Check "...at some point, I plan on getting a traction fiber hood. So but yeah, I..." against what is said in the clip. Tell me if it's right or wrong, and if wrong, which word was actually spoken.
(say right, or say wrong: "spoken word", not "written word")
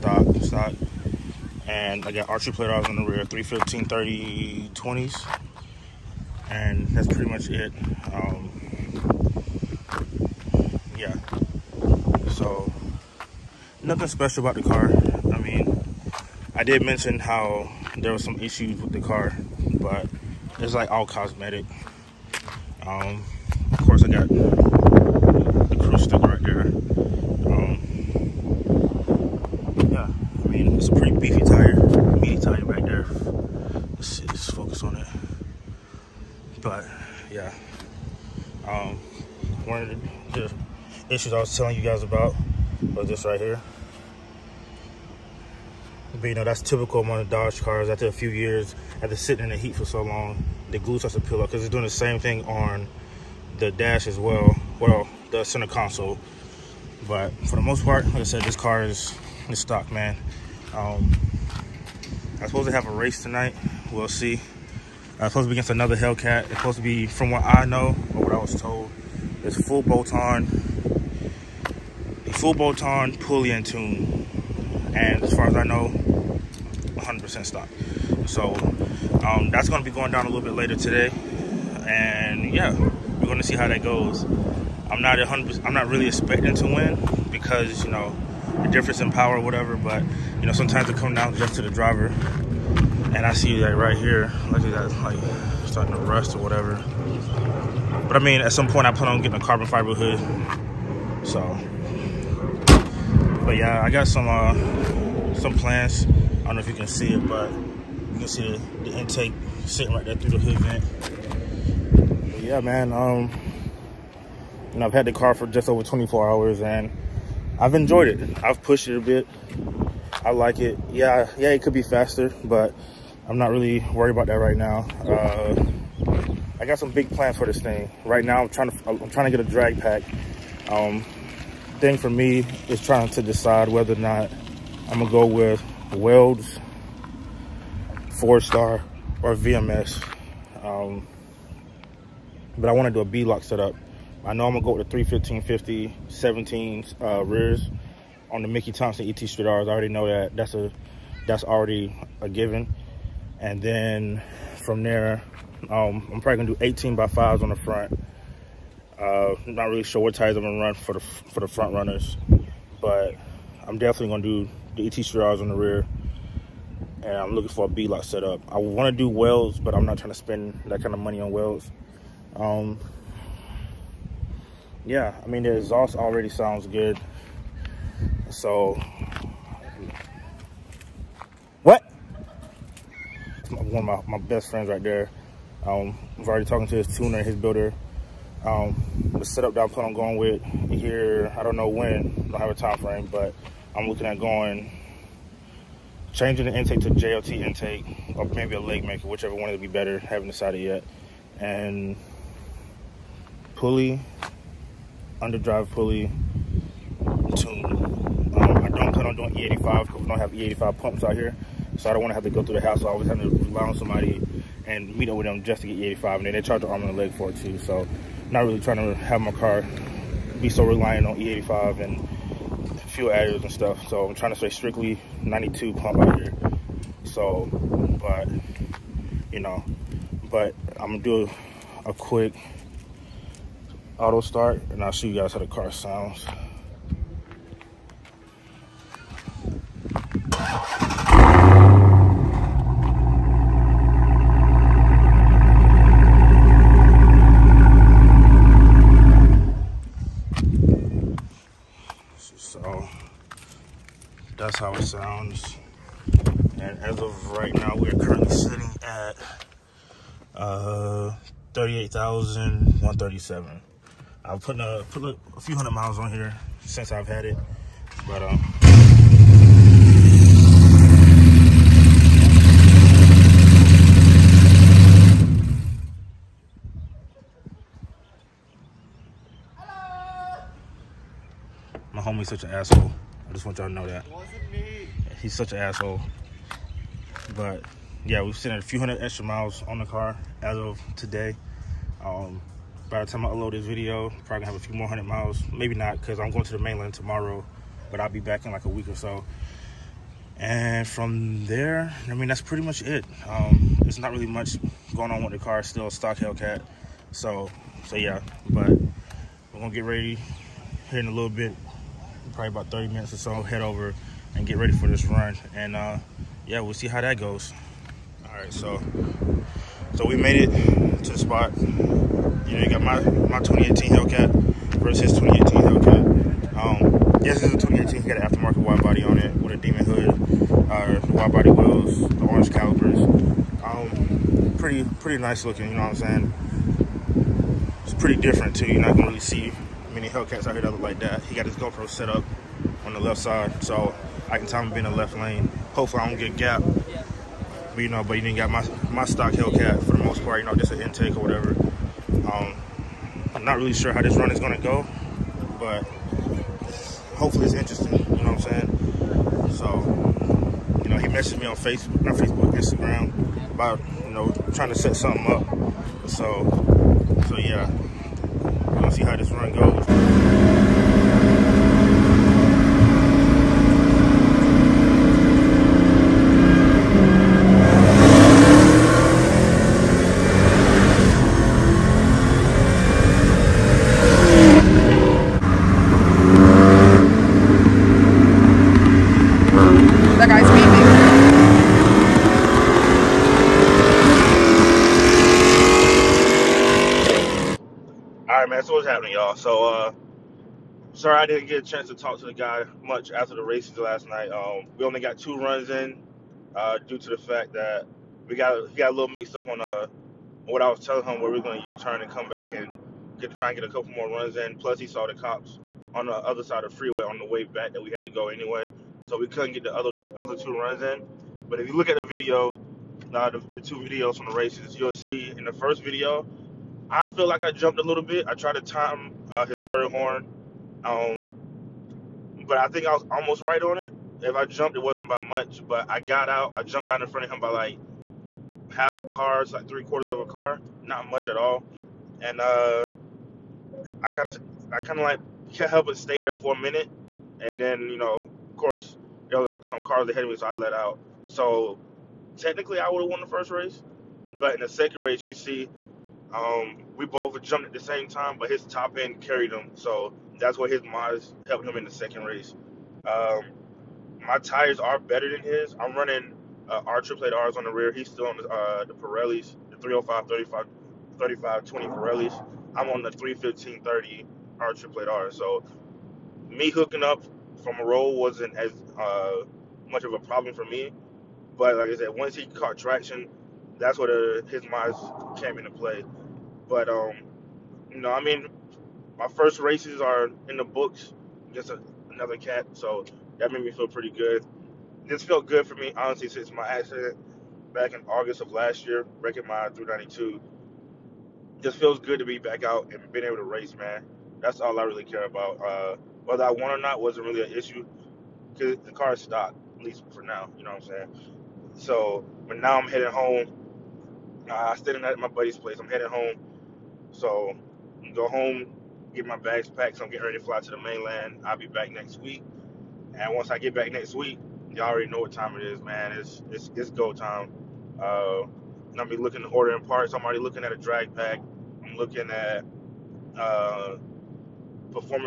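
wrong: "carbon", not "traction".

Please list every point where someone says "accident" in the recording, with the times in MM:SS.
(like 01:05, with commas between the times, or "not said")
08:16.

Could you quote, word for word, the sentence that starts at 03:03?
One of my, my best friends right there.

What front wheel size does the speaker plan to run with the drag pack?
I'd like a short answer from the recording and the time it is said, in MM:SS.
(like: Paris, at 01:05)
18 by 5, at 02:36.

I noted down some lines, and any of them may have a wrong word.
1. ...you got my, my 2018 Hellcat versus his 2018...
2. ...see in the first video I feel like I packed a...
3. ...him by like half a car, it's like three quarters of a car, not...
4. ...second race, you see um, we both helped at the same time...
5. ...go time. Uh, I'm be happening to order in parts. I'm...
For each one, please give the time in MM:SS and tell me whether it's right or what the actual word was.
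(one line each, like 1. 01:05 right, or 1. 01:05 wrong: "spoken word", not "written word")
1. 05:22 right
2. 07:04 wrong: "jumped", not "packed"
3. 07:17 right
4. 07:34 wrong: "jumped", not "helped"
5. 08:46 wrong: "looking", not "happening".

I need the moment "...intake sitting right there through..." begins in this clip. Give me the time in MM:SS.
01:48.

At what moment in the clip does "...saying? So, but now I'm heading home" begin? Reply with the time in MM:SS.
08:31.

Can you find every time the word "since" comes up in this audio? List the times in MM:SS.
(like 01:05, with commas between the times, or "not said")
04:26, 08:16.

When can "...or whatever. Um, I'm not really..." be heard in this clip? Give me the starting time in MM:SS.
05:51.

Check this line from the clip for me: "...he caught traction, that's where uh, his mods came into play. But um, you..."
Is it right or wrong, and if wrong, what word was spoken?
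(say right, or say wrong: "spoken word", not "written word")
right.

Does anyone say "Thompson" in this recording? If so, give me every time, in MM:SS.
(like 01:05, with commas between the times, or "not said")
02:28.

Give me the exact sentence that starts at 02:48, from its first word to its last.
I want to do Welds, but I'm not trying to spend that kind of money on Welds.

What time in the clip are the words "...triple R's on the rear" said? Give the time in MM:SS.
07:47.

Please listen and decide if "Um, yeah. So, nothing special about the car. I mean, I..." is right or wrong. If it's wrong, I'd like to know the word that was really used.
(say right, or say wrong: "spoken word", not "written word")
right.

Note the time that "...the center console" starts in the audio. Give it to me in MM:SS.
00:55.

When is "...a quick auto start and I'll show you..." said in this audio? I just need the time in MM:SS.
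03:51.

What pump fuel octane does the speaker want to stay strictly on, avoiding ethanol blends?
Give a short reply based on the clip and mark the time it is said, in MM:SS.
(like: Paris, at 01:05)
92, at 03:45.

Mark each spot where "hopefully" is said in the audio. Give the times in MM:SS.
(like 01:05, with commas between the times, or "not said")
05:45, 05:57.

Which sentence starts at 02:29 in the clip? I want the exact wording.
I already know that that's a that's already a given.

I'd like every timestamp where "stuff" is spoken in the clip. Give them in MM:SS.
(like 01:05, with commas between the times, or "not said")
03:43.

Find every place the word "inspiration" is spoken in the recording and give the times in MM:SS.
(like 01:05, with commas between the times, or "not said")
not said.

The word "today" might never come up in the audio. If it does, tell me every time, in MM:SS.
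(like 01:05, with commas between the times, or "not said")
01:20, 04:50.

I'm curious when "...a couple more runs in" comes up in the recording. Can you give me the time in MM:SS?
06:53.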